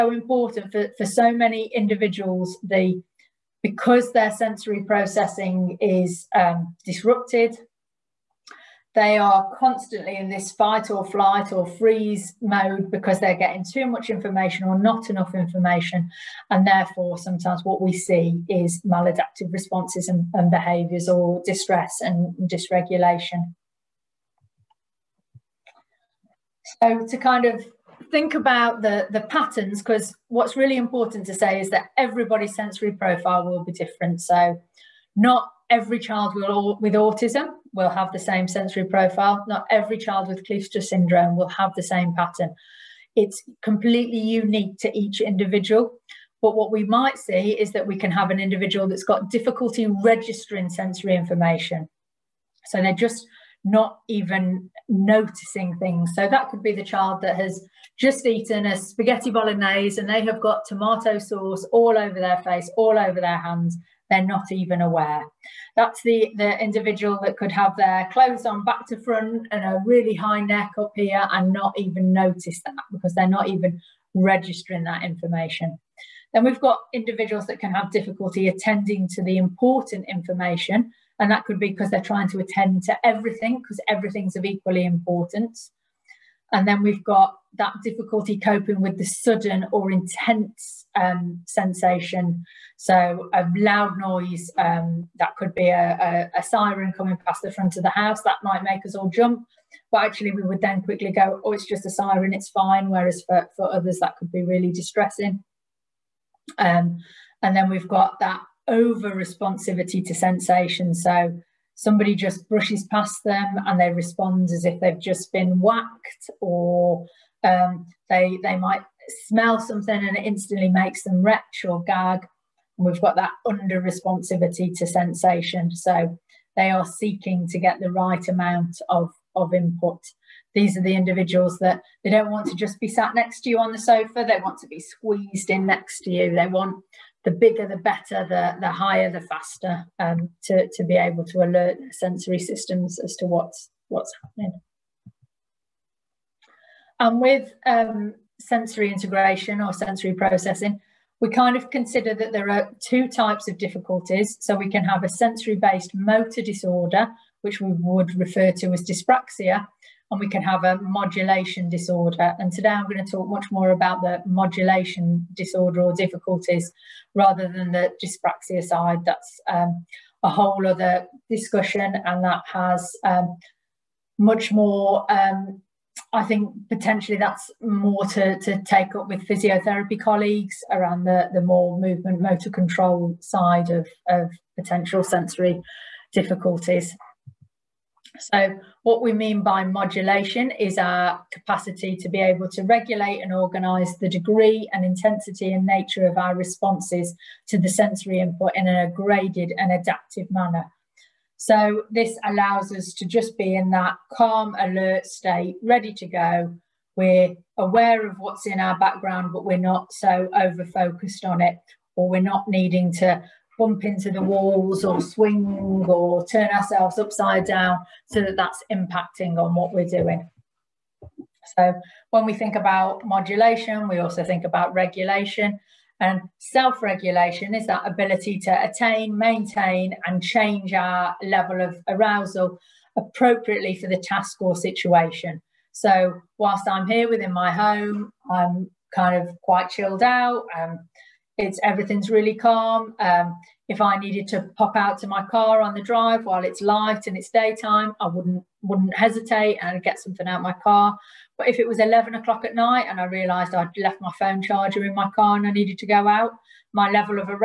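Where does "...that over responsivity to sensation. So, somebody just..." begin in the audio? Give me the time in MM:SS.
01:48.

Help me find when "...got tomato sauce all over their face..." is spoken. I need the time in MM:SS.
01:00.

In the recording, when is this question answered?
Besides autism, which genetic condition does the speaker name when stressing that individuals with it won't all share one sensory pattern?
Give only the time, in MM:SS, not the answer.
00:40.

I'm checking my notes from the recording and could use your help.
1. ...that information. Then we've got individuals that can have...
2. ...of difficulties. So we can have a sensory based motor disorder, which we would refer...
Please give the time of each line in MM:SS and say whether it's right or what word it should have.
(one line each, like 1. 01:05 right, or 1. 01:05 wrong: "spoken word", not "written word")
1. 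01:14 right
2. 02:33 right.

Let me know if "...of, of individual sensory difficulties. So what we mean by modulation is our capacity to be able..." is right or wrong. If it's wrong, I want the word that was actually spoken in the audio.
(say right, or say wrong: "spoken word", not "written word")
wrong: "potential", not "individual".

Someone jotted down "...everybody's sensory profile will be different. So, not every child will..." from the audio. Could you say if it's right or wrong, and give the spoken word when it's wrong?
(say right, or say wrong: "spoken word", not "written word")
right.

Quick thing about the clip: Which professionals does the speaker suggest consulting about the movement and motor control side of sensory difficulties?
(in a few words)
physiotherapy.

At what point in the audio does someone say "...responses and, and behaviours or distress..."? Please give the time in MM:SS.
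00:19.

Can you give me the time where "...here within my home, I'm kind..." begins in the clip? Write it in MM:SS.
03:56.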